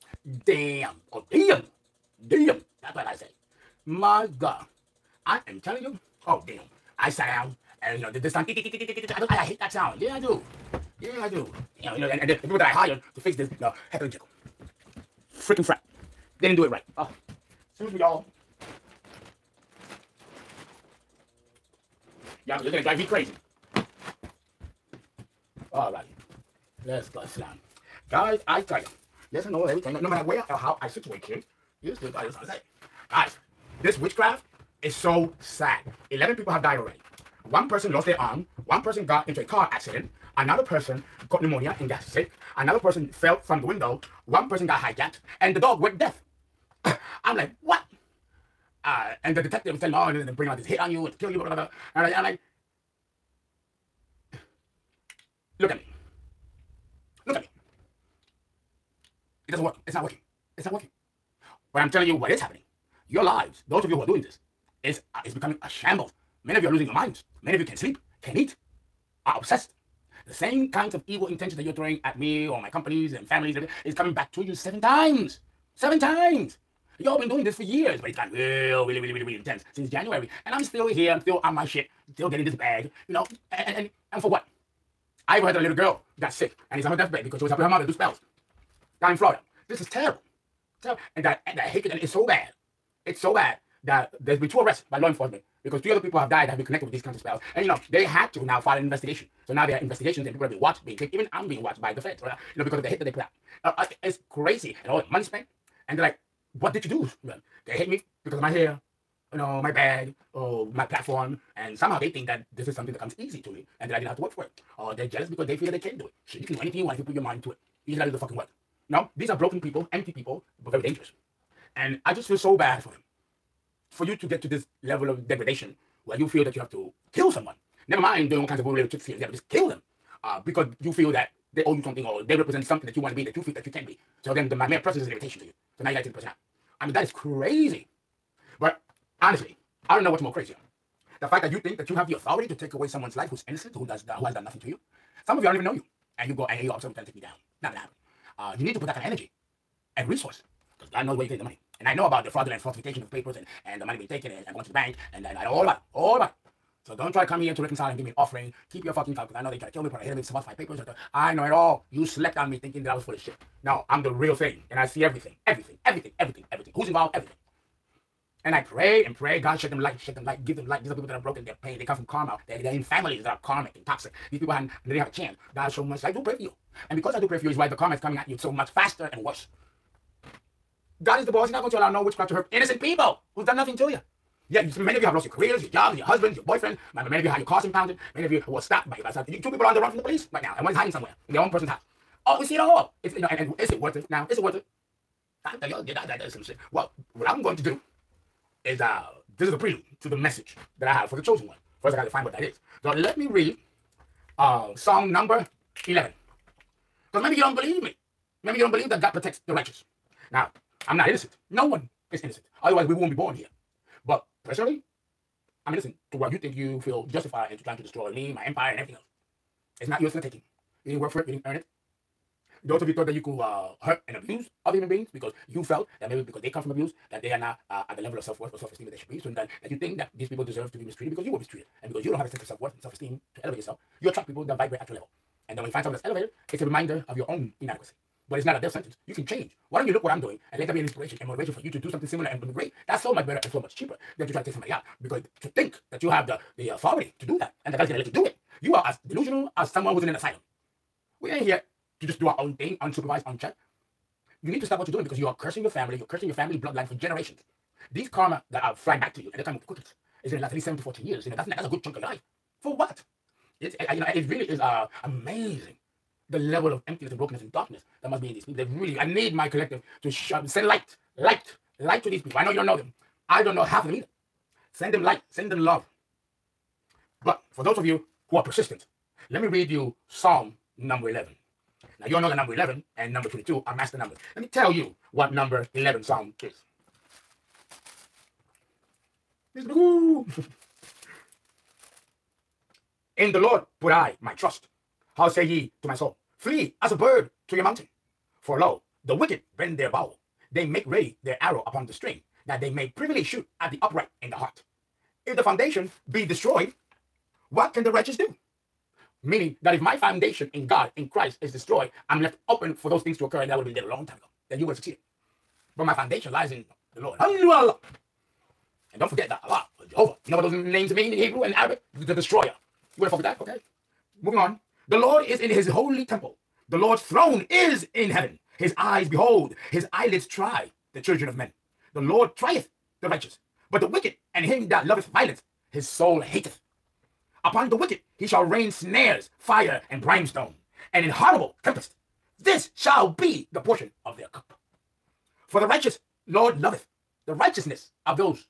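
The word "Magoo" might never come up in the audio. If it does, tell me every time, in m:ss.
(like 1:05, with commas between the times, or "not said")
4:49.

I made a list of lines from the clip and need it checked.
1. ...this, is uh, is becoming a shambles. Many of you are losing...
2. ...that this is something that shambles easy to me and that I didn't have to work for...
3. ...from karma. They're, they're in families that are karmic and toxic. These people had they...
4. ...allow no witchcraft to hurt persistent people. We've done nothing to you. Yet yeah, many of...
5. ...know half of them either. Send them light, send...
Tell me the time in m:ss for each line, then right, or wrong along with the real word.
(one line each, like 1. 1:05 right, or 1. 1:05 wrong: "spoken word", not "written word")
1. 1:04 right
2. 1:52 wrong: "comes", not "shambles"
3. 2:51 right
4. 3:01 wrong: "innocent", not "persistent"
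5. 4:33 right.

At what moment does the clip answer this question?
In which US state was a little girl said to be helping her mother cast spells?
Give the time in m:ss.
1:29.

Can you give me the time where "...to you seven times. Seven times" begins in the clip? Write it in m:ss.
1:14.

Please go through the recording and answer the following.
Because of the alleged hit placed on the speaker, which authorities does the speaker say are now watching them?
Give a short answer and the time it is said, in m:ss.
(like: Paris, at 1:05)
the feds, at 1:41.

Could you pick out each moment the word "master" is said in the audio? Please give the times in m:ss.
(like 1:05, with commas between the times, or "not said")
4:43.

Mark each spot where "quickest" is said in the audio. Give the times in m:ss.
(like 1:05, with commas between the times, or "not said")
4:19.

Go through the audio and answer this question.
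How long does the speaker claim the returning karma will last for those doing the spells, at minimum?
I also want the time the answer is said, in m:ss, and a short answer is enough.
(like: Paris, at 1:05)
7 to 14 years, at 4:20.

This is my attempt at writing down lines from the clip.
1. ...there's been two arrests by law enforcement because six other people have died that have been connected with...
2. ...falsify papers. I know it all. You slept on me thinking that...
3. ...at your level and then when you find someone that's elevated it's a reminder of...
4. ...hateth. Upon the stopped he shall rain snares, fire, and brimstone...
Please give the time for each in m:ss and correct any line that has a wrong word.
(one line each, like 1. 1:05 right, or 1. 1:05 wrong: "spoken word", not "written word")
1. 1:34 wrong: "three", not "six"
2. 2:40 right
3. 3:54 right
4. 5:36 wrong: "wicked", not "stopped".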